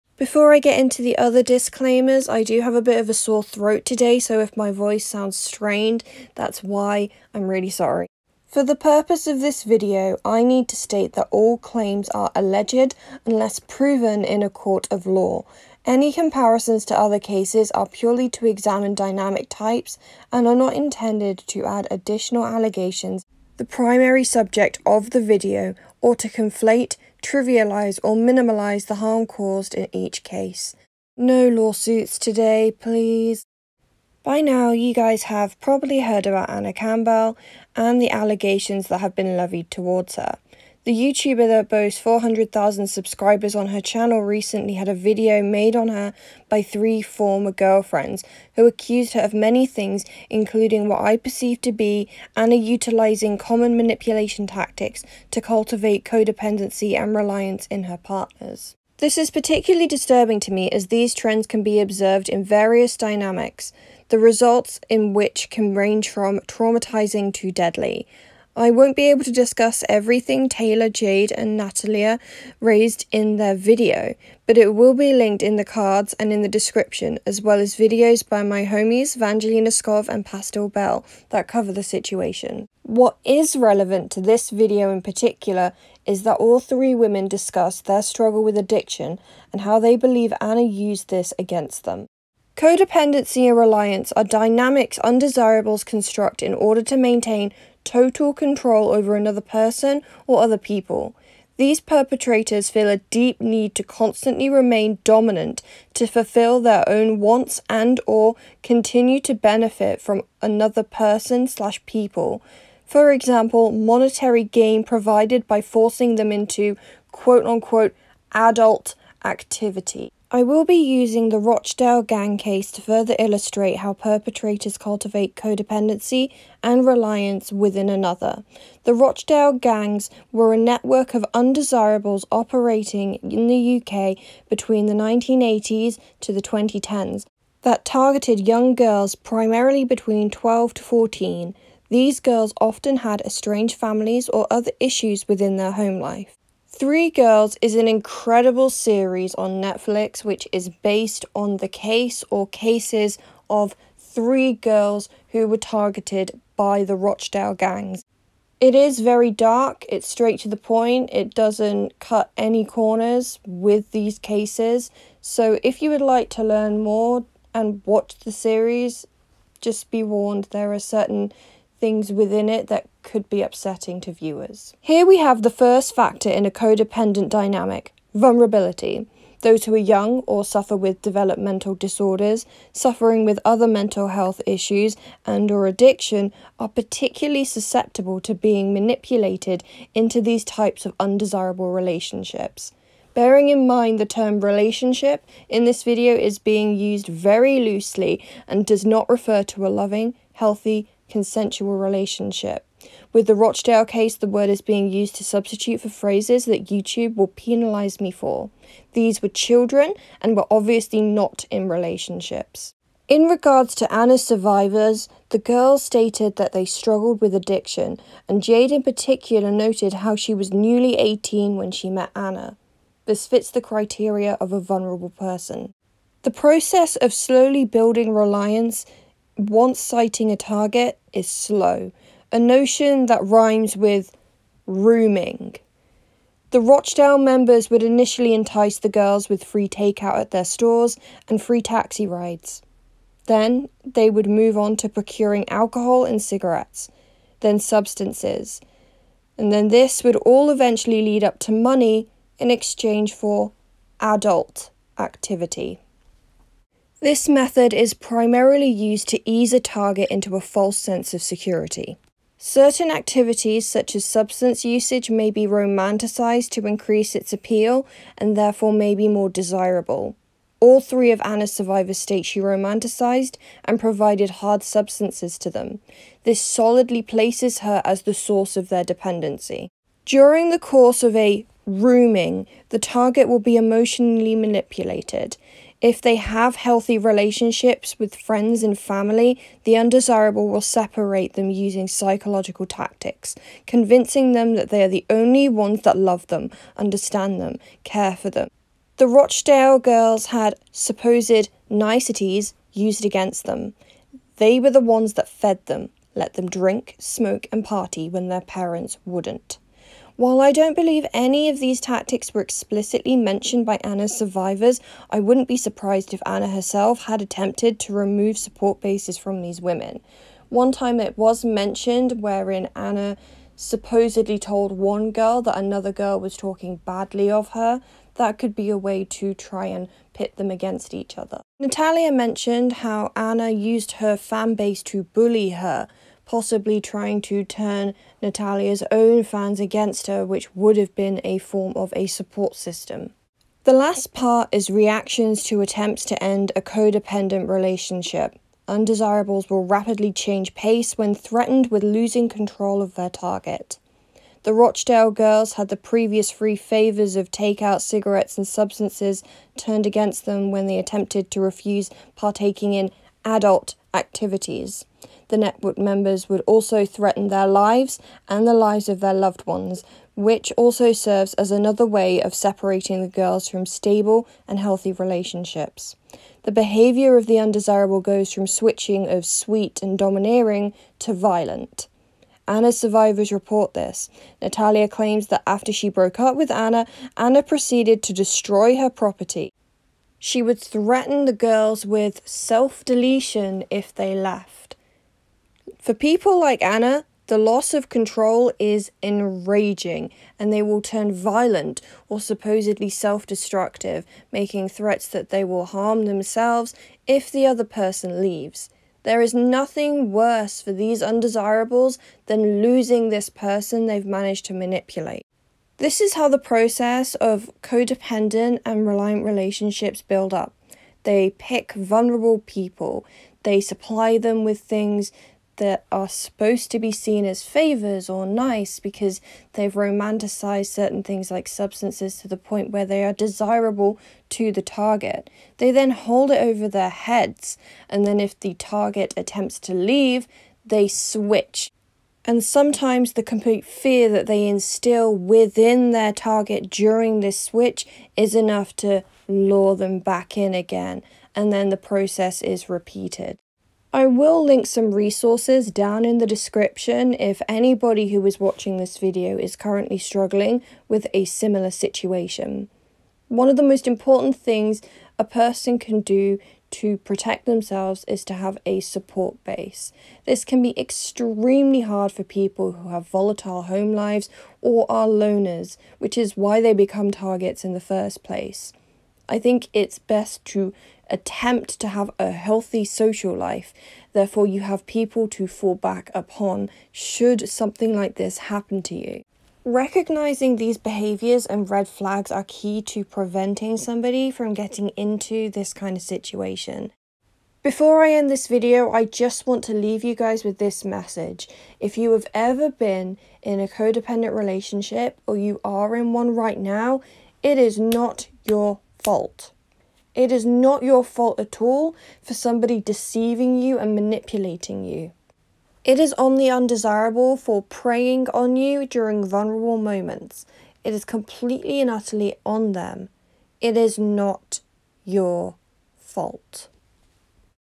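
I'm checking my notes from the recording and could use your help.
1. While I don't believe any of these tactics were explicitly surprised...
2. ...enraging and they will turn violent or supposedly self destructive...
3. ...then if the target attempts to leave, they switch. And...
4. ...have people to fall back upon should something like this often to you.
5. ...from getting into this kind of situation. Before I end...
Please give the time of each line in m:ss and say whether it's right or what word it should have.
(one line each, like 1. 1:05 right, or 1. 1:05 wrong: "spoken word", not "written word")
1. 5:10 wrong: "mentioned", not "surprised"
2. 6:39 right
3. 7:18 right
4. 8:04 wrong: "happen", not "often"
5. 8:14 right.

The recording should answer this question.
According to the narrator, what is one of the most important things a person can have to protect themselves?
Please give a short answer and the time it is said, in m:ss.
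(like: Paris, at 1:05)
A support base, at 7:48.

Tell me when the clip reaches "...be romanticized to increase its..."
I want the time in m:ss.
4:25.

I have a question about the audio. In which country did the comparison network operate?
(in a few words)
UK.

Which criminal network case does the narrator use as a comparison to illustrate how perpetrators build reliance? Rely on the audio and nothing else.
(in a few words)
Rochdale gang.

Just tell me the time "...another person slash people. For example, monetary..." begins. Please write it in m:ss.
1:50.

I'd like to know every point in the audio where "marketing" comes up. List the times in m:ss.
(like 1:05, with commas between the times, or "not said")
not said.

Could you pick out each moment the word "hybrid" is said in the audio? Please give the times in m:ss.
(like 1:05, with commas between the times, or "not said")
not said.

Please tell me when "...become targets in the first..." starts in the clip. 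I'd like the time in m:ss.
7:56.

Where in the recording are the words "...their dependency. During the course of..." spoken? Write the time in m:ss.
4:38.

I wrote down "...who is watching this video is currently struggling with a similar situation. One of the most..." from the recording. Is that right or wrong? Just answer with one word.
right.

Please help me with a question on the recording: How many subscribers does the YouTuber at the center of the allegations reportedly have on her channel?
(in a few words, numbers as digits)
400,000.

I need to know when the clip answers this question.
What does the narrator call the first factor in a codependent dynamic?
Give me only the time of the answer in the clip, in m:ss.
2:58.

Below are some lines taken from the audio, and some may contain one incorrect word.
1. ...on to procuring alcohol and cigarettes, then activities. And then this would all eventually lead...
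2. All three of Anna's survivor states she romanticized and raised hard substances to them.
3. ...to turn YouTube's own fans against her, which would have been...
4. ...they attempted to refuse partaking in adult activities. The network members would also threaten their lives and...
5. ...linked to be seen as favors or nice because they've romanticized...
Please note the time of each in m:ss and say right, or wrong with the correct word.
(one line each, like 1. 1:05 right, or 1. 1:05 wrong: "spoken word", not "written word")
1. 4:04 wrong: "substances", not "activities"
2. 4:30 wrong: "provided", not "raised"
3. 5:37 wrong: "Natalia", not "YouTube"
4. 6:00 right
5. 7:06 wrong: "supposed", not "linked".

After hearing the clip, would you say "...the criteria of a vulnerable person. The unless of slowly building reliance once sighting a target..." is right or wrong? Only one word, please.
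wrong.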